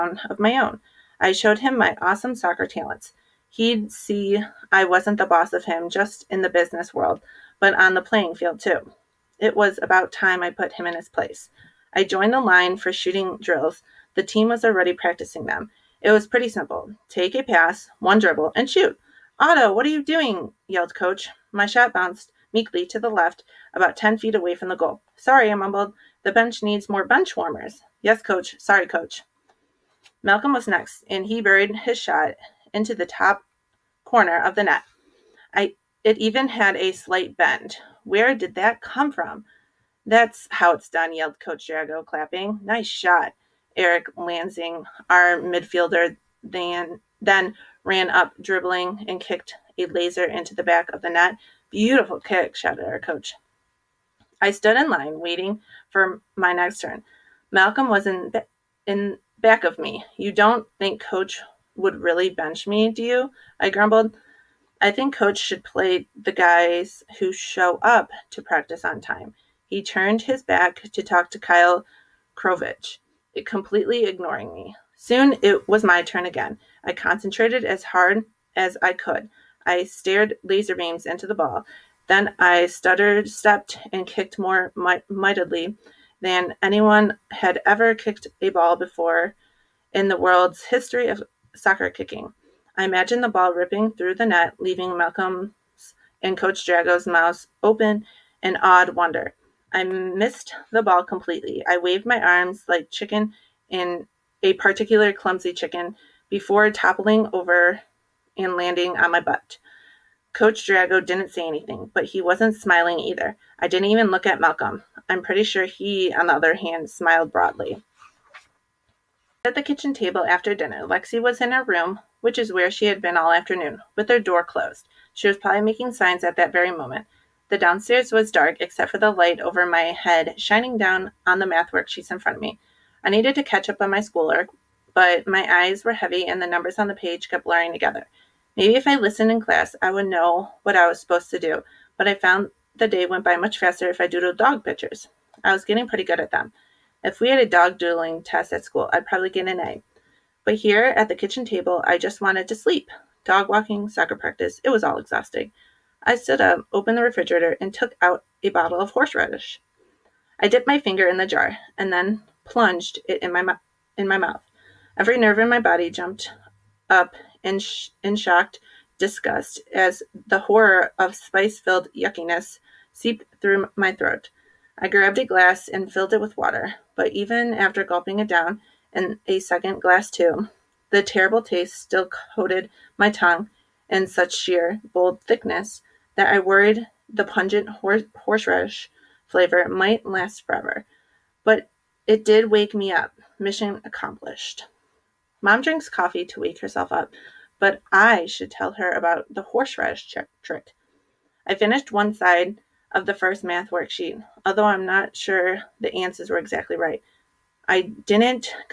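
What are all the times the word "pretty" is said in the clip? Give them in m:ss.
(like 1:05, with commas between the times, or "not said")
0:16, 1:55, 2:25.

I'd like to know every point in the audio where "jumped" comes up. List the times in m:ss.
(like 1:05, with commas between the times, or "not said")
2:45.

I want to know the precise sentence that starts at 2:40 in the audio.
I dipped my finger in the jar and then plunged it in my, mu- in my mouth.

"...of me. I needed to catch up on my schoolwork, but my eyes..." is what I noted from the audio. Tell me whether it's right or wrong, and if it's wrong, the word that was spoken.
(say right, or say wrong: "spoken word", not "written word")
right.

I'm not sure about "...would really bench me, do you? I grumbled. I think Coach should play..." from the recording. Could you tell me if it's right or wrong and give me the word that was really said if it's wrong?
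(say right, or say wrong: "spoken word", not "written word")
right.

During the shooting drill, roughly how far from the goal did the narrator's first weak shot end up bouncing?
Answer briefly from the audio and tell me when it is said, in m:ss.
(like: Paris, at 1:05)
10 feet, at 0:23.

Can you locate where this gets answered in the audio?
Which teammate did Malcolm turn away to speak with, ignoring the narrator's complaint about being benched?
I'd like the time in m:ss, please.
1:11.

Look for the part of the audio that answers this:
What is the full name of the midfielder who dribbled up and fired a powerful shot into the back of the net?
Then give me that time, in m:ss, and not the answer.
0:43.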